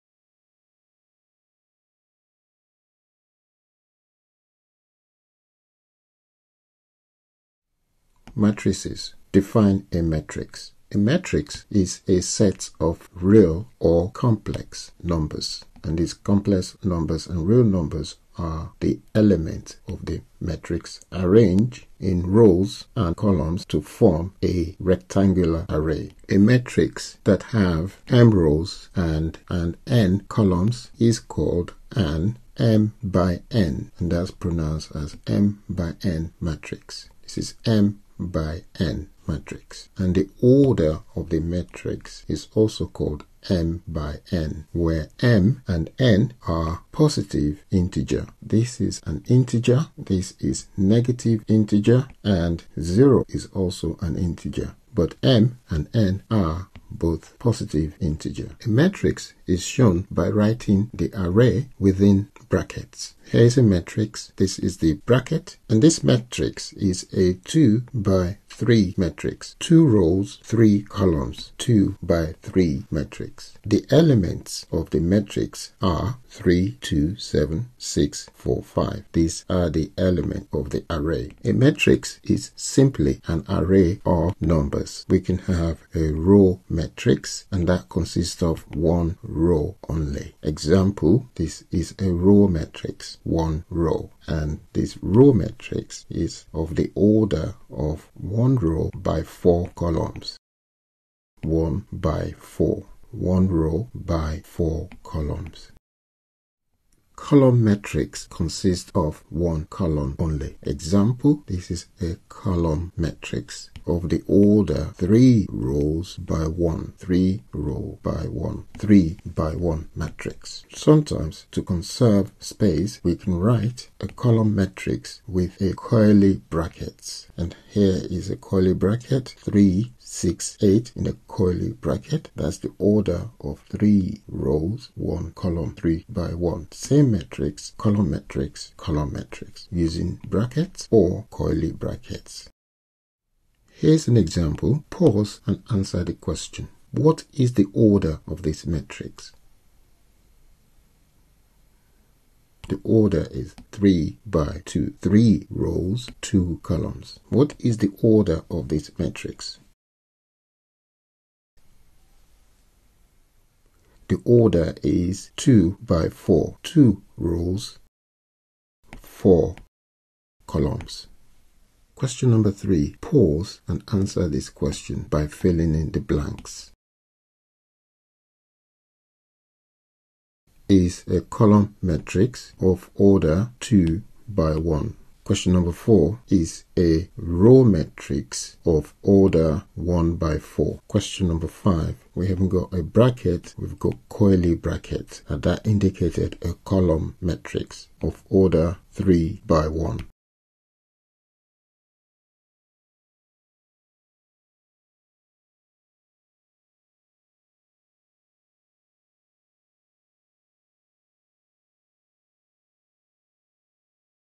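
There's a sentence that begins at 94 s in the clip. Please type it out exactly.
And this row matrix is of the order of 1 one row by four columns.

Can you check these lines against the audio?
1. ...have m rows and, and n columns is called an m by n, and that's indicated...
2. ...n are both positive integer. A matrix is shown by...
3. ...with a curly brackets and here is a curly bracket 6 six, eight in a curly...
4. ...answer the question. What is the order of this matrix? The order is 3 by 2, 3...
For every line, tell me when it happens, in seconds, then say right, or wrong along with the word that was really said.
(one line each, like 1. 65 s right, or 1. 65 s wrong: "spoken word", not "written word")
1. 27 s wrong: "pronounced", not "indicated"
2. 55 s right
3. 125 s wrong: "3", not "6"
4. 145 s right.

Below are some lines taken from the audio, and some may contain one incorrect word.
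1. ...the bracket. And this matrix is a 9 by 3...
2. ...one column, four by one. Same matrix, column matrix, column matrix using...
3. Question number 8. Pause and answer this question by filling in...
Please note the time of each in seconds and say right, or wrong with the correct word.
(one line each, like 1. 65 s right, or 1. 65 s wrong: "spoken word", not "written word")
1. 64 s wrong: "2", not "9"
2. 134 s wrong: "three", not "four"
3. 171 s wrong: "3", not "8".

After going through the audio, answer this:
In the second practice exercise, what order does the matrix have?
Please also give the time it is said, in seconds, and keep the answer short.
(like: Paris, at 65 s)
2 by 4, at 165 s.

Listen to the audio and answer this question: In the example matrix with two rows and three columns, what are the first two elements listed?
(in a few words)
3, 2.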